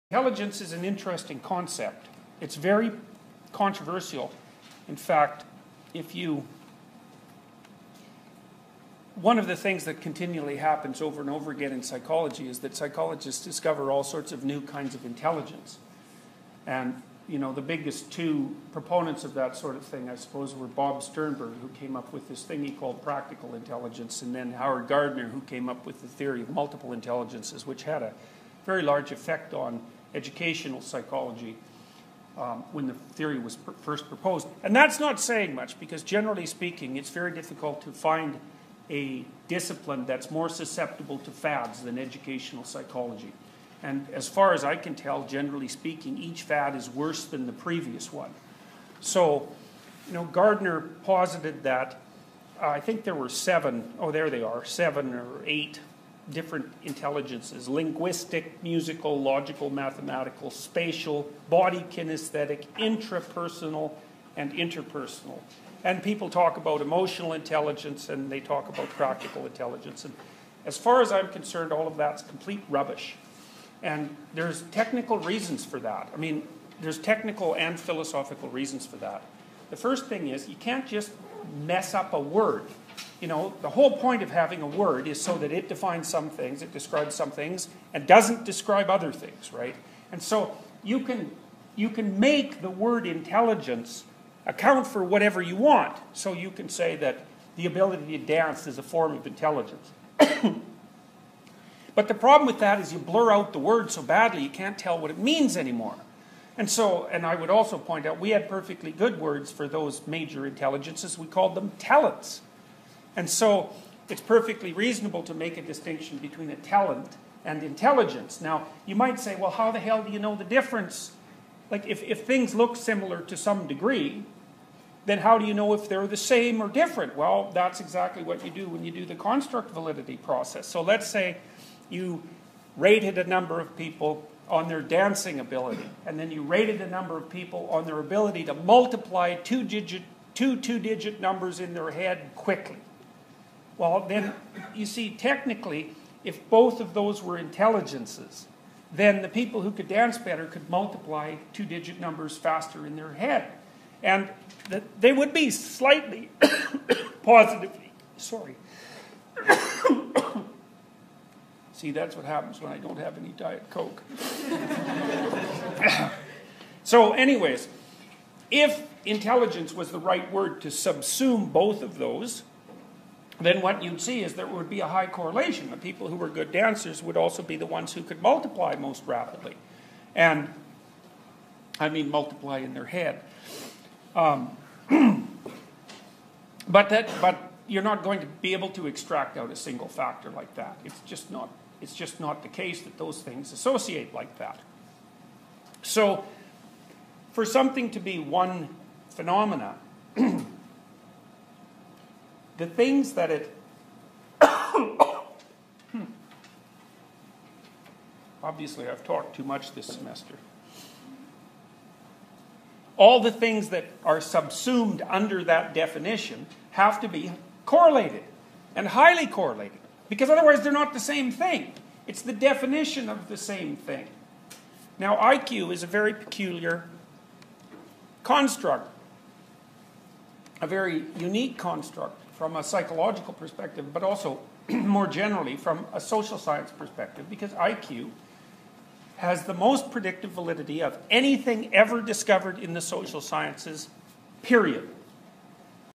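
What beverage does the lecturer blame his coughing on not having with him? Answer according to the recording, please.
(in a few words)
Diet Coke.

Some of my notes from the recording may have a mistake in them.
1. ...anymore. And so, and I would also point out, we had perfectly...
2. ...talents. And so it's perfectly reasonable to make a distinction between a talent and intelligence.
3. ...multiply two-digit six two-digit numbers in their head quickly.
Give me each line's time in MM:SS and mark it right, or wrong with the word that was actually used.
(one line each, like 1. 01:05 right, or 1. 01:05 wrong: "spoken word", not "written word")
1. 01:45 right
2. 01:51 right
3. 02:18 wrong: "two", not "six".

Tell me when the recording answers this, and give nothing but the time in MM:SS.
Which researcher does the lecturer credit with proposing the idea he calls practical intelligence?
00:20.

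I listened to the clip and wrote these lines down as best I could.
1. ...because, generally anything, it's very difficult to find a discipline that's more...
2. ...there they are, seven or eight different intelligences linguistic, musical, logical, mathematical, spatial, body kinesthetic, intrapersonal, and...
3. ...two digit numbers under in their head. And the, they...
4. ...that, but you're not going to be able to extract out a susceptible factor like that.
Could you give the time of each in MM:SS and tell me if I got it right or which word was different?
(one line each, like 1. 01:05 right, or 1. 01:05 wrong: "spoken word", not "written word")
1. 00:35 wrong: "speaking", not "anything"
2. 00:54 right
3. 02:31 wrong: "faster", not "under"
4. 03:06 wrong: "single", not "susceptible".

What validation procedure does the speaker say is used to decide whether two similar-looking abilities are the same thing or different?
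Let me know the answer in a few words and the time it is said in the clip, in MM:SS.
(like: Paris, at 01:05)
construct validity process, at 02:09.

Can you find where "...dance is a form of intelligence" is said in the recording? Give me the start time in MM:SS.
01:38.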